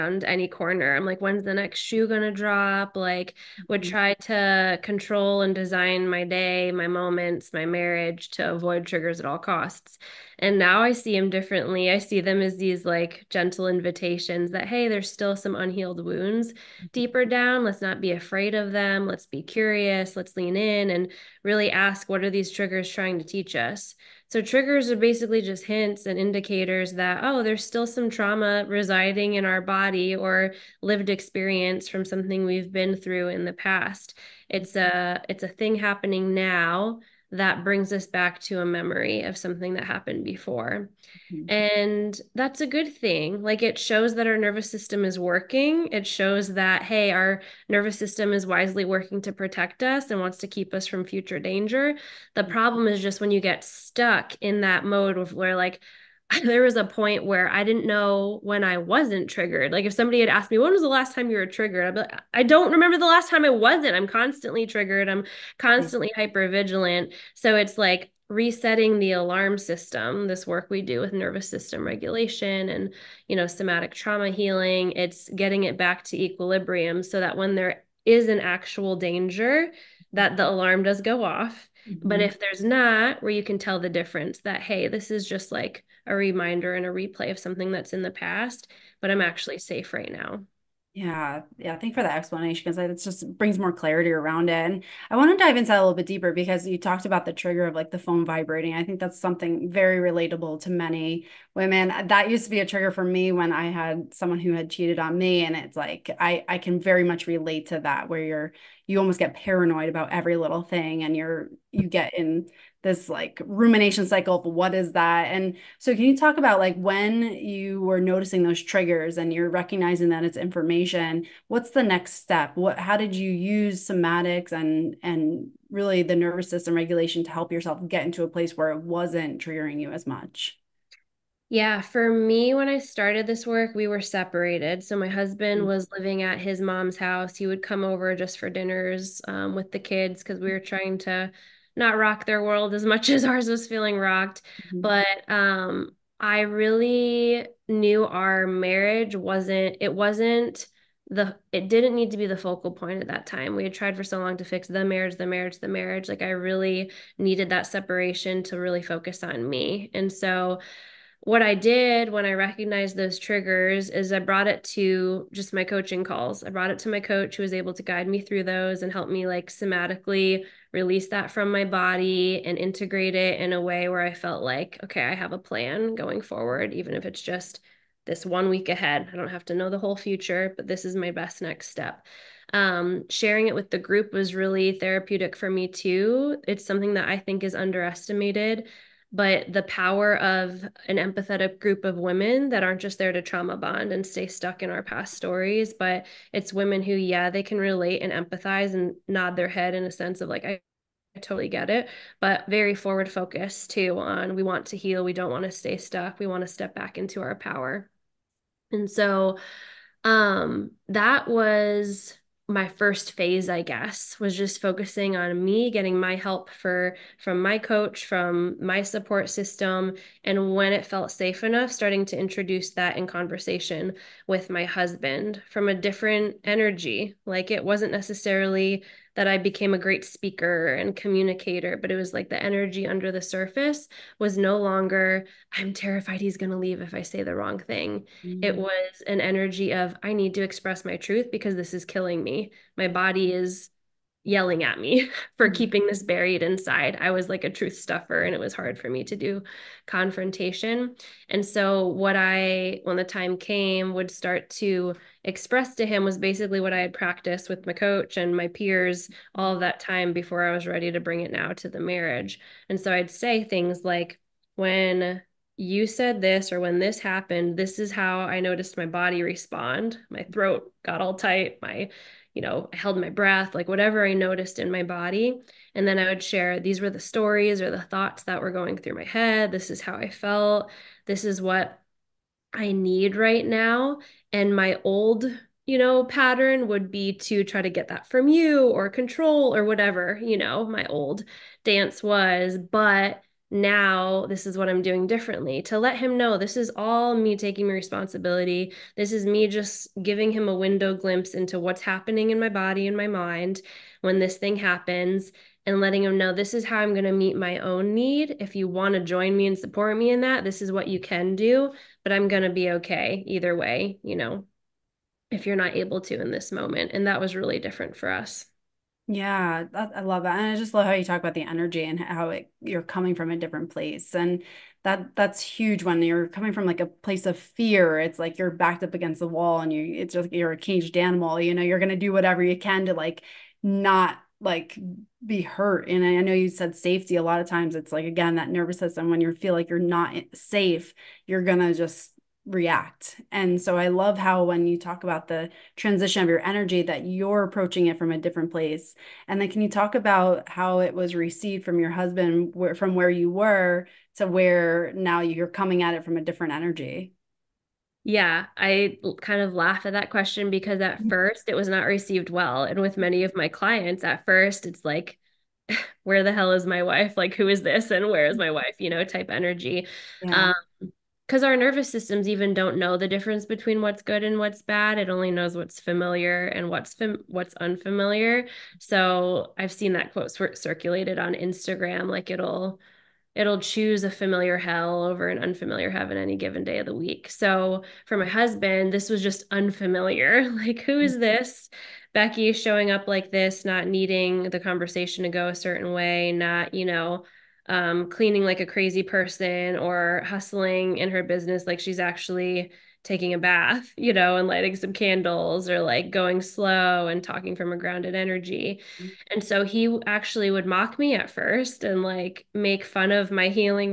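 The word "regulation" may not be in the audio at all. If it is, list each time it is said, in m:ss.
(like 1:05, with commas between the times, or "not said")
1:11, 2:06.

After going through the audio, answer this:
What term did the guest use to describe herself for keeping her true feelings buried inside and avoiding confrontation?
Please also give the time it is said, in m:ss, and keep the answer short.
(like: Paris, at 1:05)
Truth stuffer, at 4:07.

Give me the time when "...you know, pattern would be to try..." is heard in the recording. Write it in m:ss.
4:45.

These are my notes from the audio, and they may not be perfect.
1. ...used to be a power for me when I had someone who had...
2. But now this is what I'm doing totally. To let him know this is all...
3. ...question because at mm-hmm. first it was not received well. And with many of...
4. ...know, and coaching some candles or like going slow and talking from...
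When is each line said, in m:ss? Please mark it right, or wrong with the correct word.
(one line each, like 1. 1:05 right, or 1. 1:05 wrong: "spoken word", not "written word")
1. 1:42 wrong: "trigger", not "power"
2. 4:52 wrong: "differently", not "totally"
3. 6:00 right
4. 6:44 wrong: "lighting", not "coaching".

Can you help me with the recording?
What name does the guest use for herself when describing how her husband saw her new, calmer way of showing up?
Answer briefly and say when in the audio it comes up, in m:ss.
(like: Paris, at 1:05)
Becky, at 6:32.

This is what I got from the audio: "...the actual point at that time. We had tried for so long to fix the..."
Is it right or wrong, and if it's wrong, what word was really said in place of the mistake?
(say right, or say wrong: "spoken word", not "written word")
wrong: "focal", not "actual".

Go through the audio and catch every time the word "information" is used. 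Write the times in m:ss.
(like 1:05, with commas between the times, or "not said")
2:00.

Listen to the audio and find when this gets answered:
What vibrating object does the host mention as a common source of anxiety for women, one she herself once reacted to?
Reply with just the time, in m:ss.
1:37.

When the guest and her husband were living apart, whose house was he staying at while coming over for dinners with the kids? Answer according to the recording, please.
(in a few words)
His mom's house.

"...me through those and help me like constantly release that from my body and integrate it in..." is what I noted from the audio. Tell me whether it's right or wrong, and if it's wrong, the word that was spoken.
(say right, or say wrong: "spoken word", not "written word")
wrong: "somatically", not "constantly".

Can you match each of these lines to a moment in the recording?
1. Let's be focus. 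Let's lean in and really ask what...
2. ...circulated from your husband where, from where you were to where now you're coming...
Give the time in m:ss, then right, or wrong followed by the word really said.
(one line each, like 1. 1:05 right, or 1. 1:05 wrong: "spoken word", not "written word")
1. 0:19 wrong: "curious", not "focus"
2. 5:51 wrong: "received", not "circulated".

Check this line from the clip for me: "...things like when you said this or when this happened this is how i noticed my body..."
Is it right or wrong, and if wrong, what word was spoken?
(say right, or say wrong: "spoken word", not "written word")
right.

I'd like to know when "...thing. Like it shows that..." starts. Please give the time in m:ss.
0:42.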